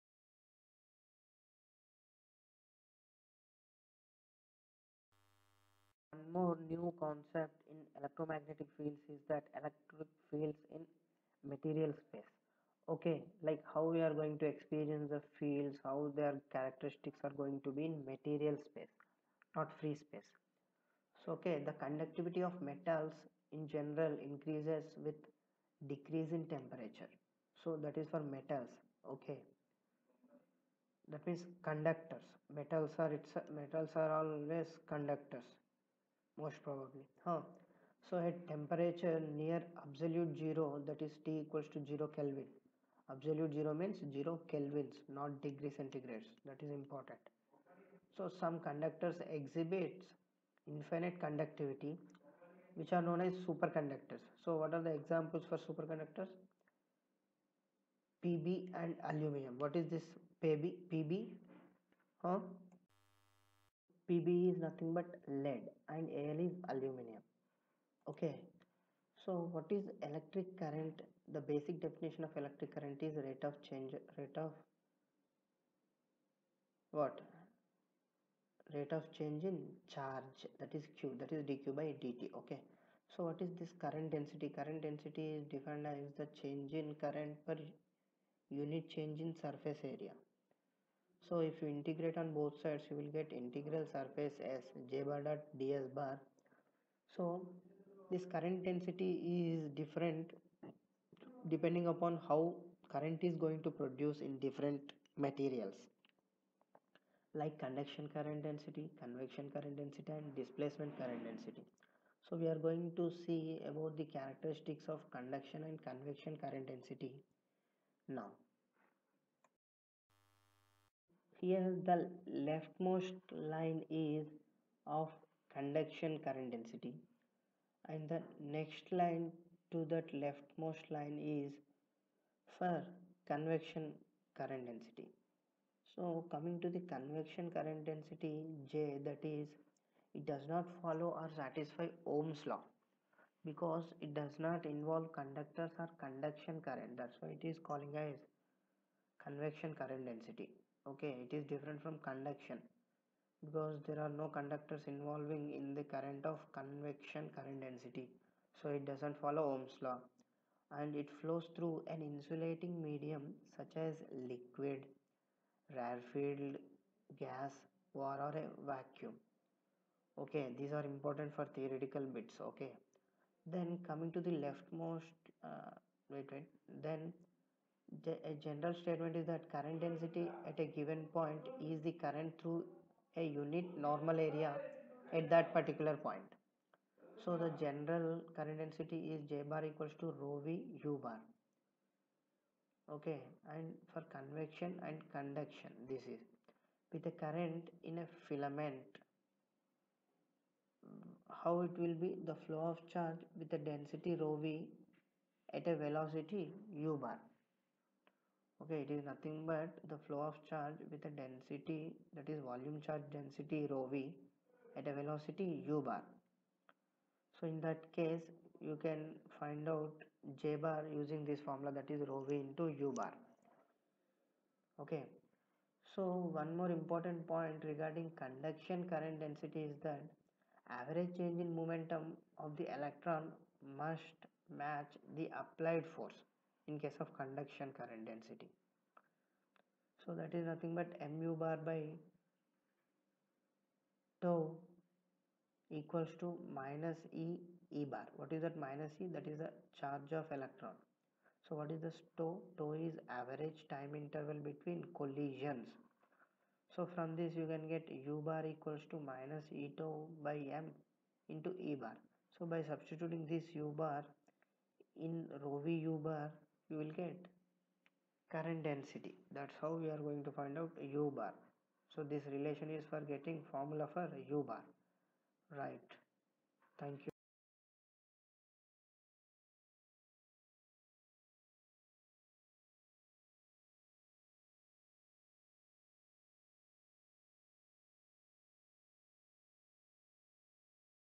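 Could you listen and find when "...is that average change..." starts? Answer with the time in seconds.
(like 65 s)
229 s.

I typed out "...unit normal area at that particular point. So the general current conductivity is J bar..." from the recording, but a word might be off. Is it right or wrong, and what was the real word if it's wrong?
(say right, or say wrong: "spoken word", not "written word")
wrong: "density", not "conductivity".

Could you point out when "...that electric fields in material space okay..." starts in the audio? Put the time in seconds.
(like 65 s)
9 s.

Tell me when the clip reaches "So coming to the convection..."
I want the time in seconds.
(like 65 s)
135 s.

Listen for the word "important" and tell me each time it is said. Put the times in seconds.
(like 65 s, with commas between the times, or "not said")
46 s, 170 s, 226 s.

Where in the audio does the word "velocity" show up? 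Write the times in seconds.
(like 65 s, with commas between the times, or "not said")
205 s, 214 s.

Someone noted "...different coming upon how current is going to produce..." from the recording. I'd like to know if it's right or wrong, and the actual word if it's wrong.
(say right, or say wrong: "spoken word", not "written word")
wrong: "depending", not "coming".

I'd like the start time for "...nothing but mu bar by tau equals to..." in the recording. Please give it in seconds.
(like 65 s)
240 s.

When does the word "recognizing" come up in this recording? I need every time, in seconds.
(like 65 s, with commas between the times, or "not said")
not said.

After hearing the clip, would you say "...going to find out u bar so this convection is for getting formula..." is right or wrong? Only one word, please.
wrong.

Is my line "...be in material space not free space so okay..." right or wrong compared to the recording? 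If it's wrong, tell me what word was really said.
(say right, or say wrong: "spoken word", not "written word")
right.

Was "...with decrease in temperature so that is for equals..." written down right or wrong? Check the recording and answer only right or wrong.
wrong.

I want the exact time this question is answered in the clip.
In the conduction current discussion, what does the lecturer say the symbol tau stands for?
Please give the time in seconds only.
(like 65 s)
253 s.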